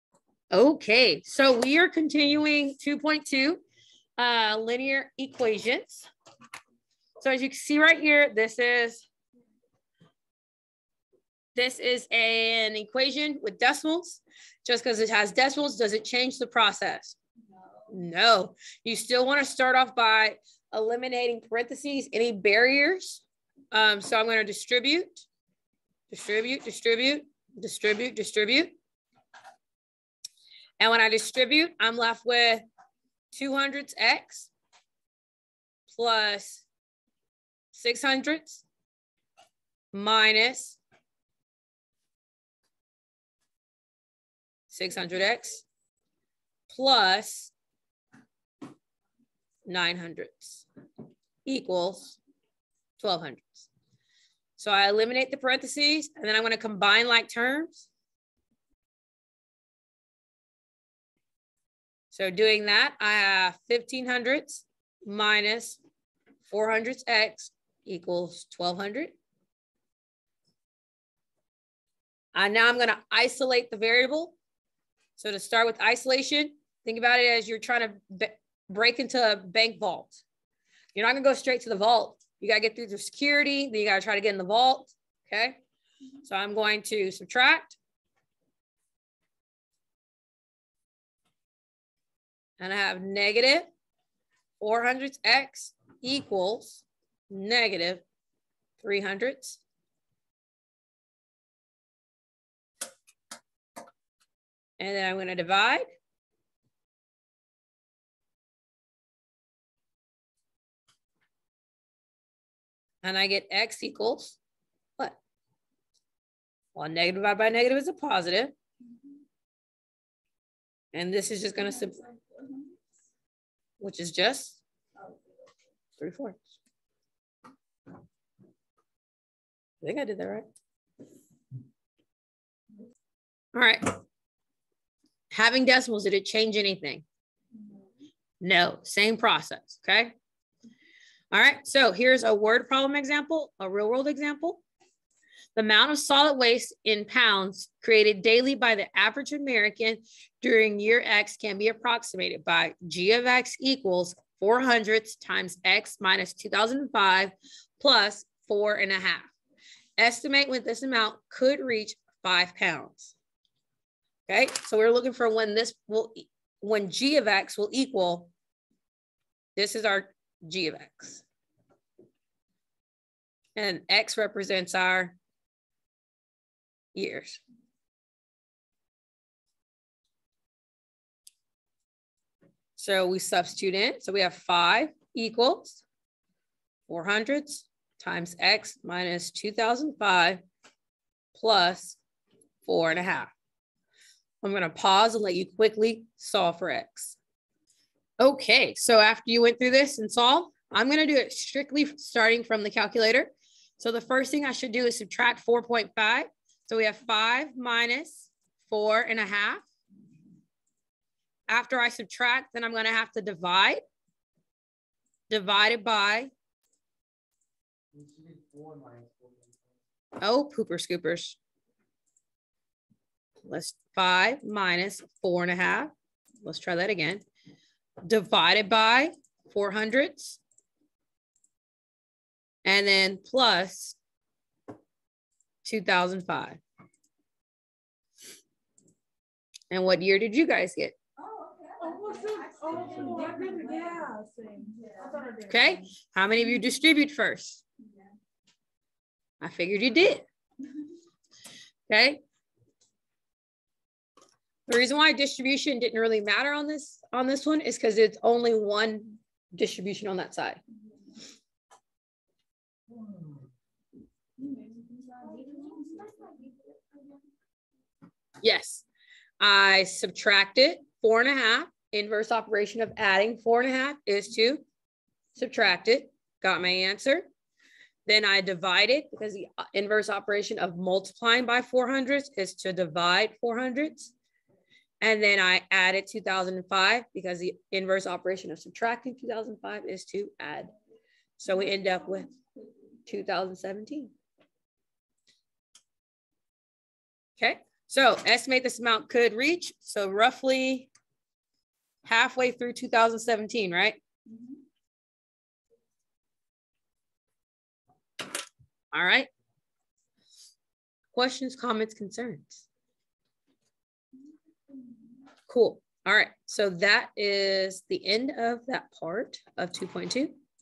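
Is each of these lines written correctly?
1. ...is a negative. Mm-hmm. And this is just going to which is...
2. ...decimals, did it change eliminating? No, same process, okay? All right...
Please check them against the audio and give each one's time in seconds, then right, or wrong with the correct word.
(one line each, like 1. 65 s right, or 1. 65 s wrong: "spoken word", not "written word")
1. 117 s wrong: "positive", not "negative"
2. 135 s wrong: "anything", not "eliminating".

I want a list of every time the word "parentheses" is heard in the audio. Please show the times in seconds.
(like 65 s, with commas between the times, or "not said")
21 s, 55 s.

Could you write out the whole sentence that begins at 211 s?
After I subtract, then I'm gonna have to divide, divided by.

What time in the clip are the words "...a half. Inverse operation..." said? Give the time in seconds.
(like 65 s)
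271 s.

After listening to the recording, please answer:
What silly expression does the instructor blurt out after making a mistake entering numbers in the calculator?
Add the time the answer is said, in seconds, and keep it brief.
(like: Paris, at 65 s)
pooper scoopers, at 220 s.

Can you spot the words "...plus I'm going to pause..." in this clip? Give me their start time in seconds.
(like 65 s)
191 s.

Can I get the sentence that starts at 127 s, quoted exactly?
I think I did that right.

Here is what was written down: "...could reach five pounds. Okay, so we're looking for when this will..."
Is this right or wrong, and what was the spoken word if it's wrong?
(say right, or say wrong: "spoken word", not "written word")
right.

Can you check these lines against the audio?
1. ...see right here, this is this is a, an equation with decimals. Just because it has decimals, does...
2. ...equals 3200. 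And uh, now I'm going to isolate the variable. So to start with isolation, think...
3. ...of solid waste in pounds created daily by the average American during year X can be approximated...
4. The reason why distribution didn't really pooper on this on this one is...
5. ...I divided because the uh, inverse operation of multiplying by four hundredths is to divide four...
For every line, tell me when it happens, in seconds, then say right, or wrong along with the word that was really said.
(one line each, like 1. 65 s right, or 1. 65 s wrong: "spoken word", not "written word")
1. 7 s right
2. 67 s wrong: "1200", not "3200"
3. 145 s right
4. 254 s wrong: "matter", not "pooper"
5. 278 s right.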